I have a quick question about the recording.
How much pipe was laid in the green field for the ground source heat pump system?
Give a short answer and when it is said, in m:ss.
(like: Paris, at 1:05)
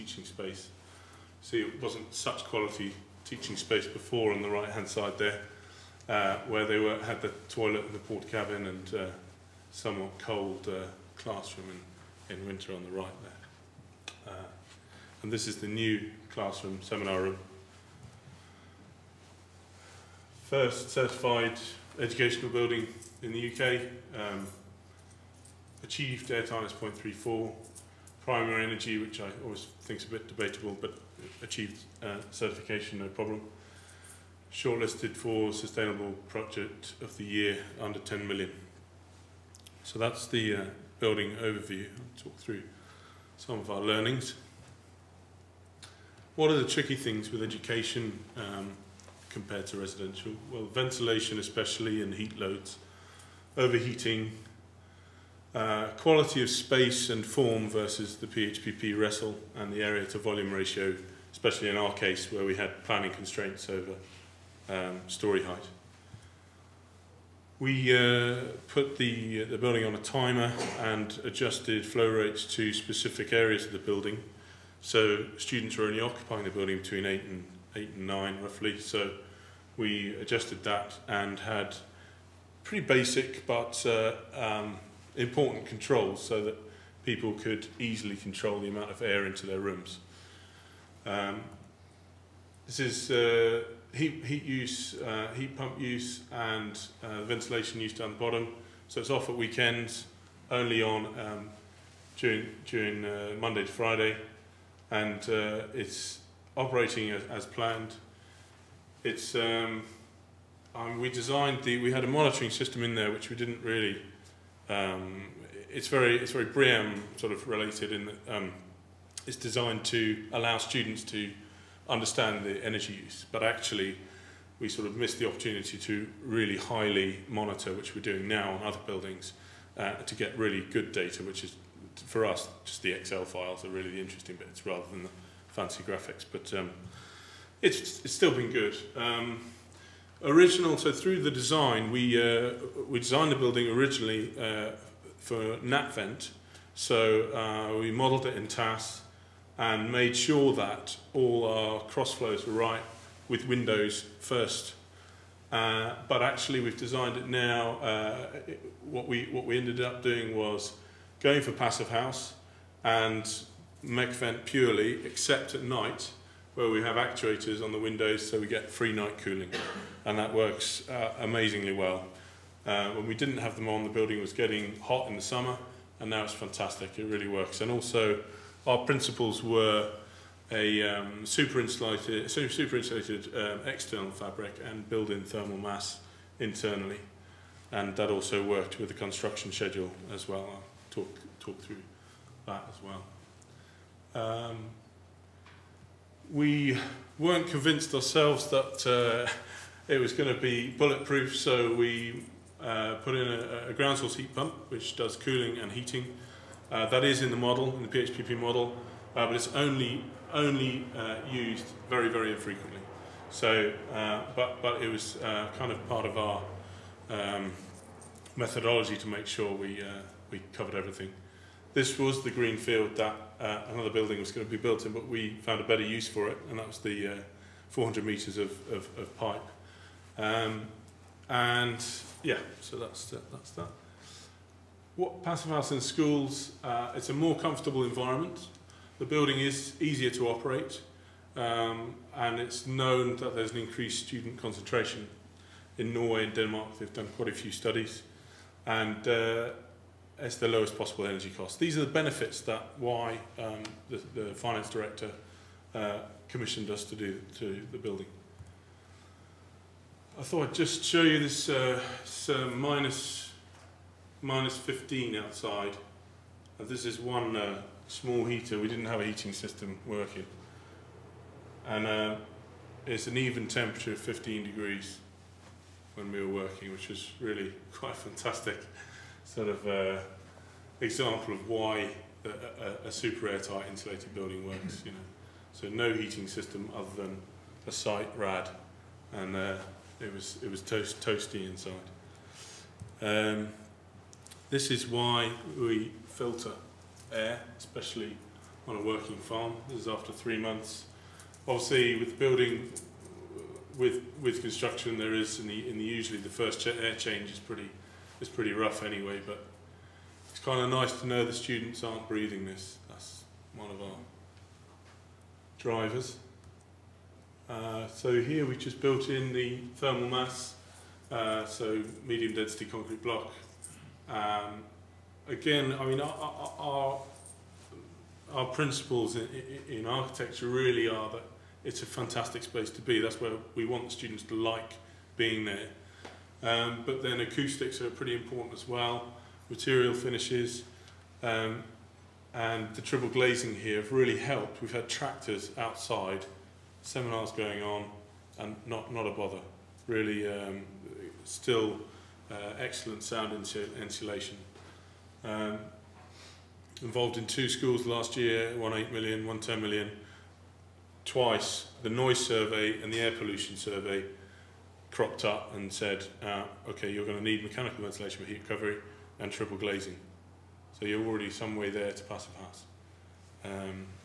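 400 metres, at 3:47.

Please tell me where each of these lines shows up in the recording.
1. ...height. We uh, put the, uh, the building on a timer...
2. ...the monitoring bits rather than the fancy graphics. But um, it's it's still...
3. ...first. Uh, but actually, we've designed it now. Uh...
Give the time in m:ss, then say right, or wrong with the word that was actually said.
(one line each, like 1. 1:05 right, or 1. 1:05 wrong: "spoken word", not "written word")
1. 1:05 right
2. 2:13 wrong: "interesting", not "monitoring"
3. 2:34 right.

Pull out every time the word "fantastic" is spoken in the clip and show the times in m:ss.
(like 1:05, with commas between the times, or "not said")
2:56, 4:37, 5:31.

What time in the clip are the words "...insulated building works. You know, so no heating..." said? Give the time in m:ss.
4:43.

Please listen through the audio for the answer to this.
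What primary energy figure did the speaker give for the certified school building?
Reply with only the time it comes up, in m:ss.
0:26.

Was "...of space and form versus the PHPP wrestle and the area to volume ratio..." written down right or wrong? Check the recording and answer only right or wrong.
right.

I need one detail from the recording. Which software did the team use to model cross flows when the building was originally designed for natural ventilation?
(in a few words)
TAS.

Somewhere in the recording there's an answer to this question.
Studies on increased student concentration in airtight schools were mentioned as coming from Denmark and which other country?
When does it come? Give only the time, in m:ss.
4:05.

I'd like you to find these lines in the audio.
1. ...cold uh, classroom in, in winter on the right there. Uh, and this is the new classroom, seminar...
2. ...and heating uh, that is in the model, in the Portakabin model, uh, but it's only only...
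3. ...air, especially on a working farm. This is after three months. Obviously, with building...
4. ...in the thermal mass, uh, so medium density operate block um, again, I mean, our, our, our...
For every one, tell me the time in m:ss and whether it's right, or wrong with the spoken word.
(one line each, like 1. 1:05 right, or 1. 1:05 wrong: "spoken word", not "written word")
1. 0:10 right
2. 3:25 wrong: "PHPP", not "Portakabin"
3. 4:57 right
4. 5:19 wrong: "concrete", not "operate".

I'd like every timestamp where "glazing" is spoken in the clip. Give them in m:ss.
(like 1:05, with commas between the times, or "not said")
5:43, 6:09.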